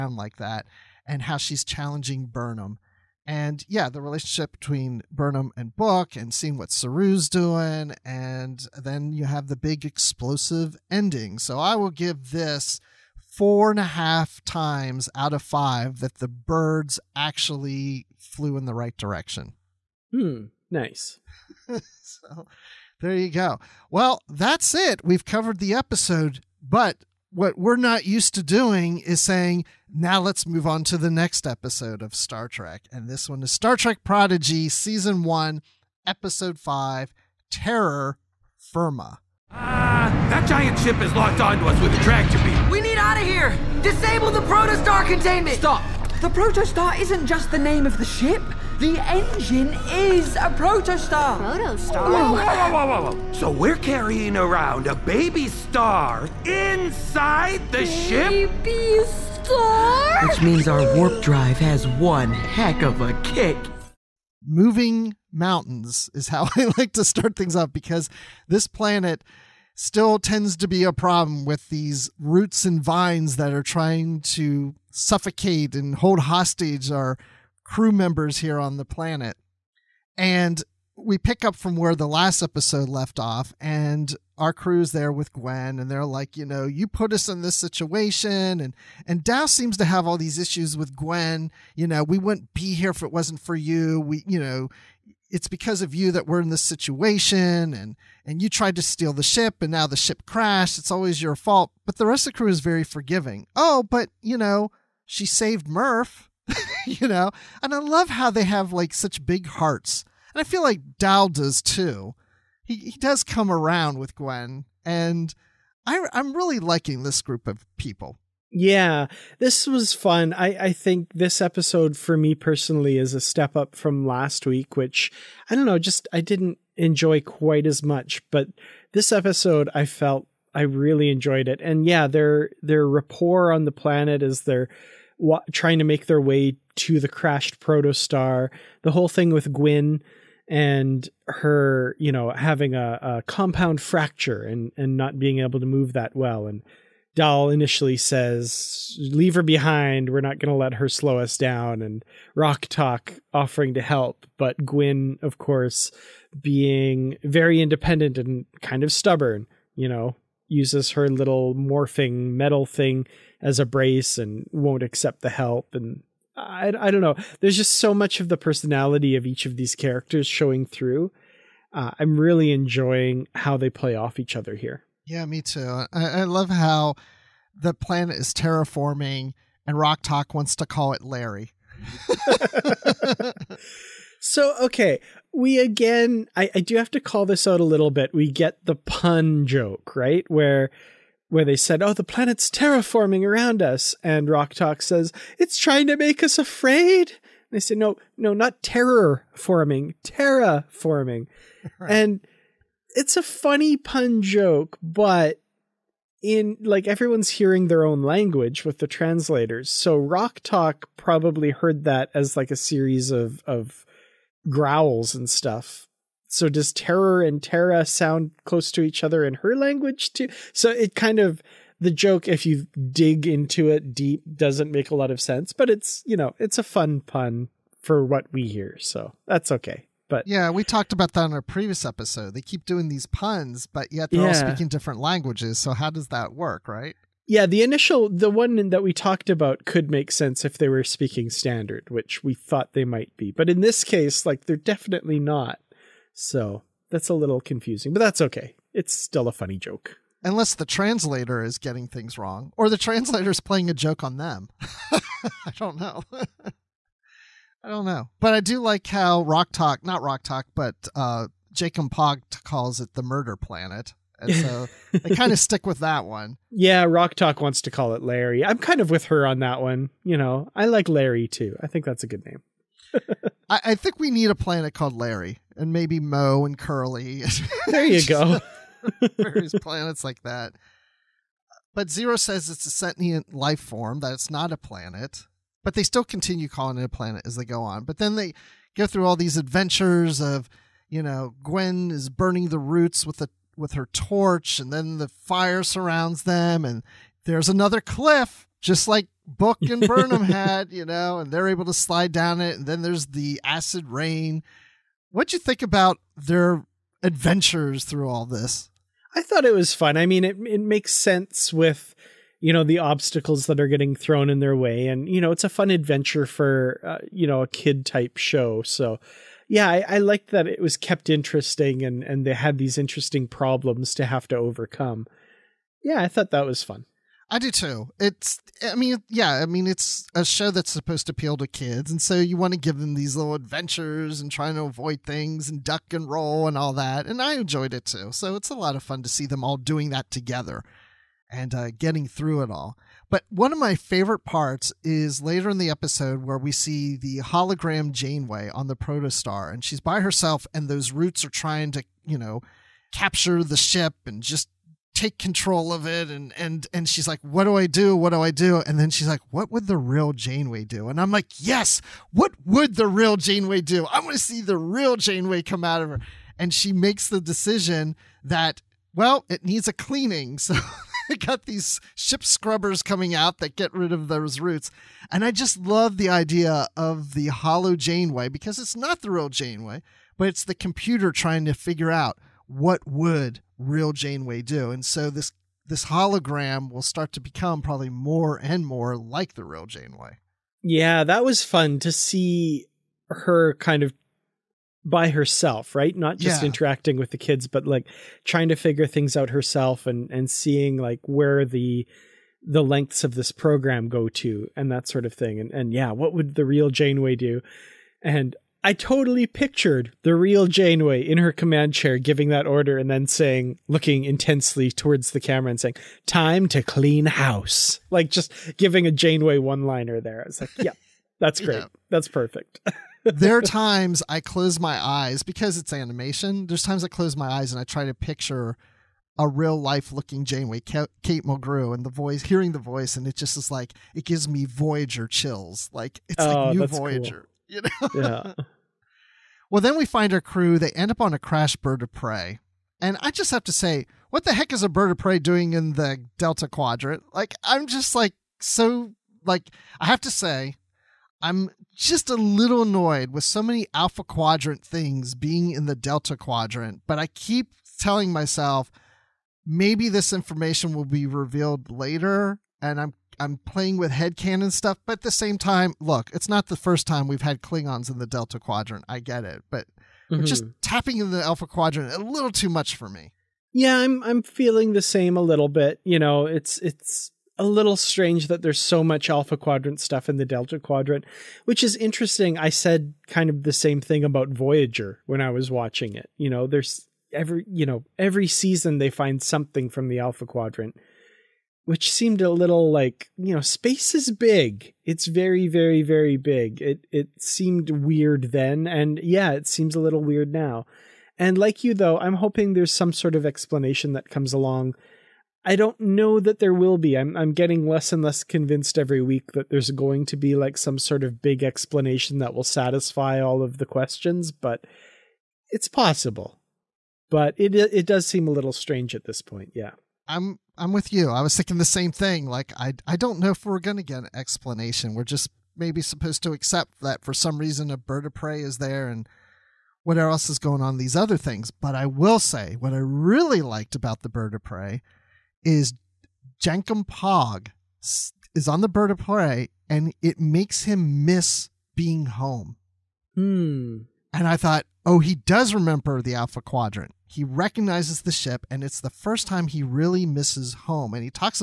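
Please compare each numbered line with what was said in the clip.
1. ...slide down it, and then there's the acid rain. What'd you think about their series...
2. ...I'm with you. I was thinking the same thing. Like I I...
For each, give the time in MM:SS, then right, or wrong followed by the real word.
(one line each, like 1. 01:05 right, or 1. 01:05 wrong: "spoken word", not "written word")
1. 05:01 wrong: "adventures", not "series"
2. 08:40 right.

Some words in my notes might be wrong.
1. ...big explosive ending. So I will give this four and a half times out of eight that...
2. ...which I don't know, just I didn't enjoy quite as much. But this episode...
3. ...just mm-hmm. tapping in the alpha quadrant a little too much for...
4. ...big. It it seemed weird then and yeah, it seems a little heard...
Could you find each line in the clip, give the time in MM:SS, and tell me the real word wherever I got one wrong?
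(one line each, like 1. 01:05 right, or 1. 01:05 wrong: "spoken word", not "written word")
1. 00:09 wrong: "five", not "eight"
2. 02:04 right
3. 07:50 right
4. 08:16 wrong: "weird", not "heard".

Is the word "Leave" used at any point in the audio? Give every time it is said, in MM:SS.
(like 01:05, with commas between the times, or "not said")
02:28.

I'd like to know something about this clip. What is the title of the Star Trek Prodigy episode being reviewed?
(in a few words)
Terror Firma.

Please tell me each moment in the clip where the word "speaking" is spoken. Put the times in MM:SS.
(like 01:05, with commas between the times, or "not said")
03:54, 04:00.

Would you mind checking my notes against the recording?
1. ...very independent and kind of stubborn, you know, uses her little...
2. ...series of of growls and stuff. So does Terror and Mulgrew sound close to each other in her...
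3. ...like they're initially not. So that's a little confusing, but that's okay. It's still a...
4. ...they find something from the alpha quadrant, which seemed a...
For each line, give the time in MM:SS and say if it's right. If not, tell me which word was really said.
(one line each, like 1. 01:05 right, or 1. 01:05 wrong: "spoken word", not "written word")
1. 02:37 right
2. 03:32 wrong: "Terra", not "Mulgrew"
3. 04:04 wrong: "definitely", not "initially"
4. 08:08 right.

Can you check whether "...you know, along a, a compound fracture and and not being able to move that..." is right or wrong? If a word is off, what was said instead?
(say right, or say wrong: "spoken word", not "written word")
wrong: "having", not "along".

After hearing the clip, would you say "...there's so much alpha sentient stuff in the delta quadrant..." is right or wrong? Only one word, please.
wrong.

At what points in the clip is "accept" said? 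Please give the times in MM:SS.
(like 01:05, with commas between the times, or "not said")
02:44, 08:46.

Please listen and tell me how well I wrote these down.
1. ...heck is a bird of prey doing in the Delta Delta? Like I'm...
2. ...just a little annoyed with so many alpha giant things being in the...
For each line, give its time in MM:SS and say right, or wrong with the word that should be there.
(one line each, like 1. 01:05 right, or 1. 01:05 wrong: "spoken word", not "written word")
1. 07:24 wrong: "Quadrant", not "Delta"
2. 07:31 wrong: "quadrant", not "giant".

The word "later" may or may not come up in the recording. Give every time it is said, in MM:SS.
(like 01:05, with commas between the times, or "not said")
05:45, 07:41.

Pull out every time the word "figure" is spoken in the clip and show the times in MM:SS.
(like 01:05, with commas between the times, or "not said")
06:21, 06:38.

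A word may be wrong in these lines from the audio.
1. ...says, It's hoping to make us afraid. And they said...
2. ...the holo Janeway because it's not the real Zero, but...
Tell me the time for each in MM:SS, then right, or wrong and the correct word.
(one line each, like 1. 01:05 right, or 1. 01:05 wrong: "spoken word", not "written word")
1. 03:14 wrong: "trying", not "hoping"
2. 06:17 wrong: "Janeway", not "Zero".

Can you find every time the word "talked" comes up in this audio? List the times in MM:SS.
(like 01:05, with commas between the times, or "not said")
03:50, 03:58.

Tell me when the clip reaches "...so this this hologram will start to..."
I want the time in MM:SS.
06:24.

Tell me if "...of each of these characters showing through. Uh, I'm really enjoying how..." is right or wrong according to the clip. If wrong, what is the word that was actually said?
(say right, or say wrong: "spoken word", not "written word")
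right.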